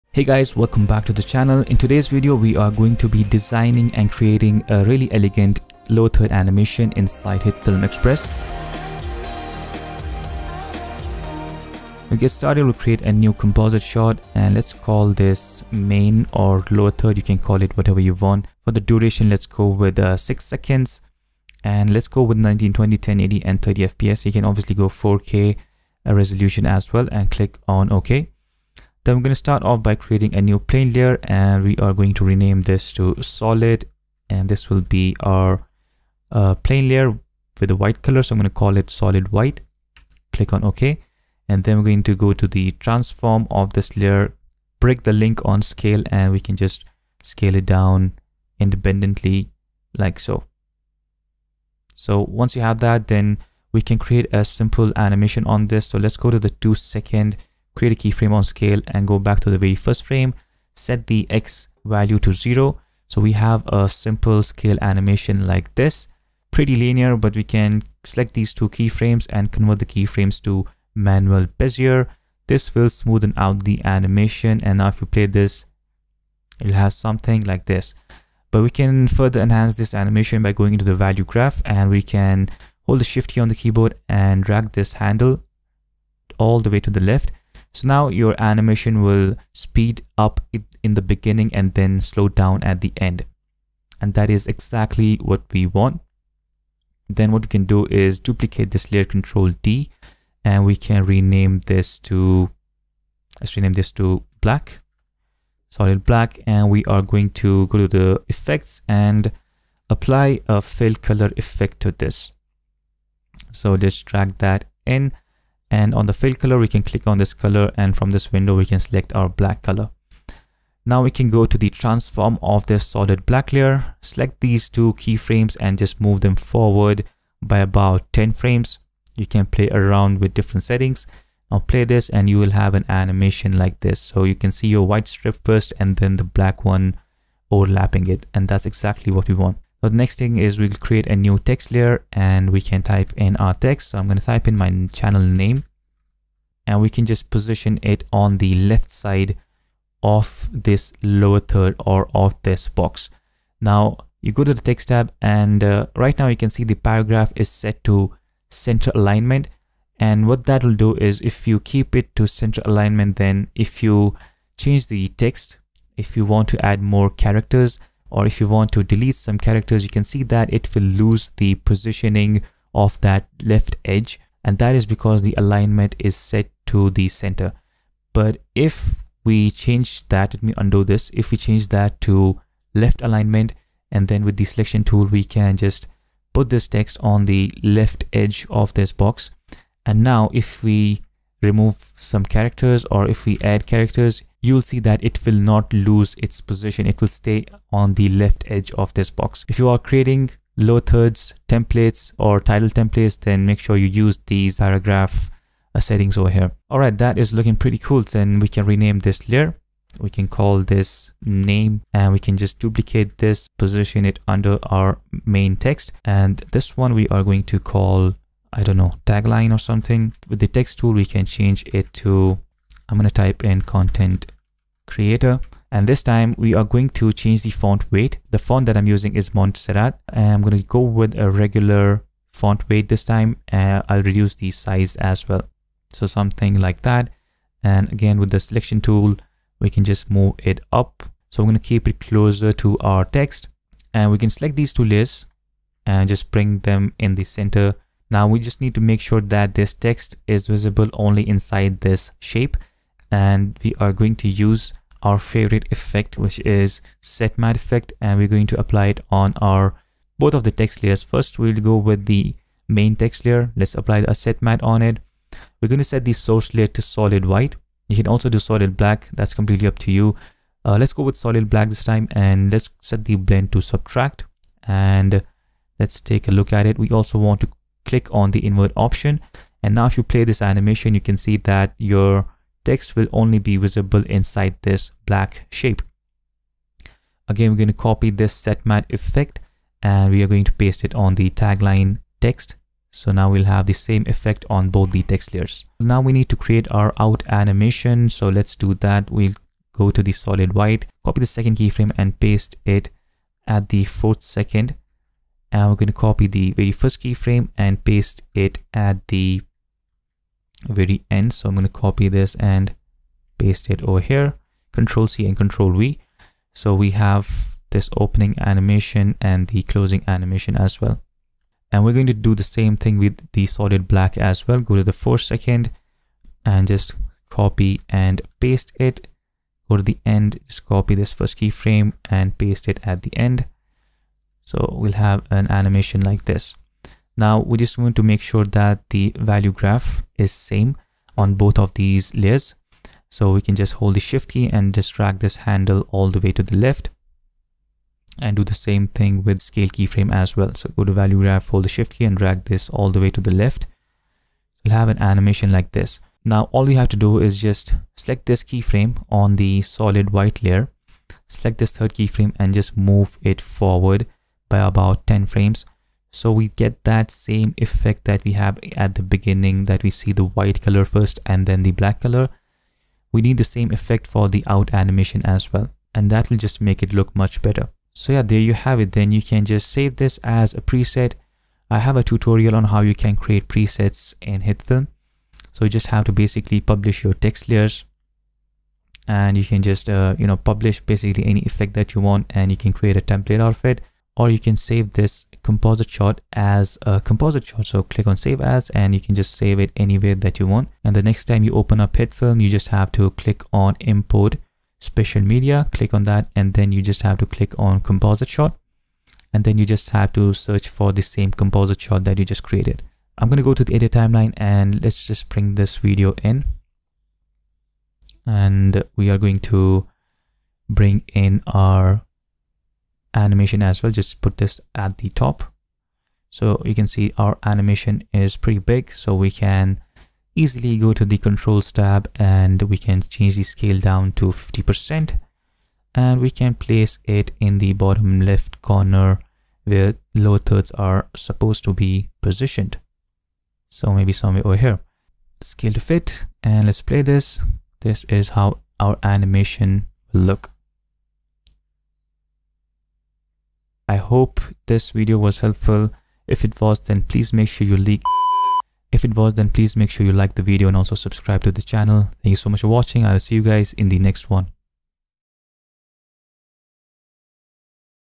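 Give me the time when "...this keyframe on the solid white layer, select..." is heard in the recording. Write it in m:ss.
5:58.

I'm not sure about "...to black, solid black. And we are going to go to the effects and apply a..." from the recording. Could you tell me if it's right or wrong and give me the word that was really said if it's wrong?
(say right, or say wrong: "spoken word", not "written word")
right.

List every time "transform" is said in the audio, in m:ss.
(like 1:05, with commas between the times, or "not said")
0:42, 2:01.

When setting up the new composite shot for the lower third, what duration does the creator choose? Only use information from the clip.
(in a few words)
6 seconds.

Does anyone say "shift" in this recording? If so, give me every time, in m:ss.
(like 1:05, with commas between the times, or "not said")
1:23, 5:43, 5:51.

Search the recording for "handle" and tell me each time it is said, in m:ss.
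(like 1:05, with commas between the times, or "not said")
1:24, 5:45.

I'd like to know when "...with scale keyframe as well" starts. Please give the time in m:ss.
5:49.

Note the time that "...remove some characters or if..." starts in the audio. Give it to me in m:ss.
3:11.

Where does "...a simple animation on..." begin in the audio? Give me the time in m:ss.
0:54.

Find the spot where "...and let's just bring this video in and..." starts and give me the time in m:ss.
6:54.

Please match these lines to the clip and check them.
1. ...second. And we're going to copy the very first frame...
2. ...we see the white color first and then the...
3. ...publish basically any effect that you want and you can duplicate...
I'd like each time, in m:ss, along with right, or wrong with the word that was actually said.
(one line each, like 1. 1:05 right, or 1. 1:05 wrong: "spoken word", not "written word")
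1. 5:04 wrong: "keyframe", not "frame"
2. 6:09 right
3. 6:30 wrong: "create", not "duplicate".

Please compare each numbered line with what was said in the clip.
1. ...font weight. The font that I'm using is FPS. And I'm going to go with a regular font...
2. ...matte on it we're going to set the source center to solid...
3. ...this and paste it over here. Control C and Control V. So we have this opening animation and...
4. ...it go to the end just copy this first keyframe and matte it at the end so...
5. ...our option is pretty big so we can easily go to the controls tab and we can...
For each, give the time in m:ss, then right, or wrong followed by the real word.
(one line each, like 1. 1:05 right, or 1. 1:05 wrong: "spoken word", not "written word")
1. 3:47 wrong: "Montserrat", not "FPS"
2. 4:24 wrong: "layer", not "center"
3. 5:12 right
4. 5:28 wrong: "paste", not "matte"
5. 7:07 wrong: "animation", not "option".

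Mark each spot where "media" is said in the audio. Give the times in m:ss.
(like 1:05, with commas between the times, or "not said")
6:45.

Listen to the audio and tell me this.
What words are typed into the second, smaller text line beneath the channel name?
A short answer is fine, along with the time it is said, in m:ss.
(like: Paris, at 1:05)
content creator, at 3:43.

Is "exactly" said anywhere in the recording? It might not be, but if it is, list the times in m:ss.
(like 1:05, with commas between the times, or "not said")
1:34, 2:18.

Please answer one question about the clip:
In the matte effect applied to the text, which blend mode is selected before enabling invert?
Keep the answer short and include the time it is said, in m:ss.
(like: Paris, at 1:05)
subtract, at 4:33.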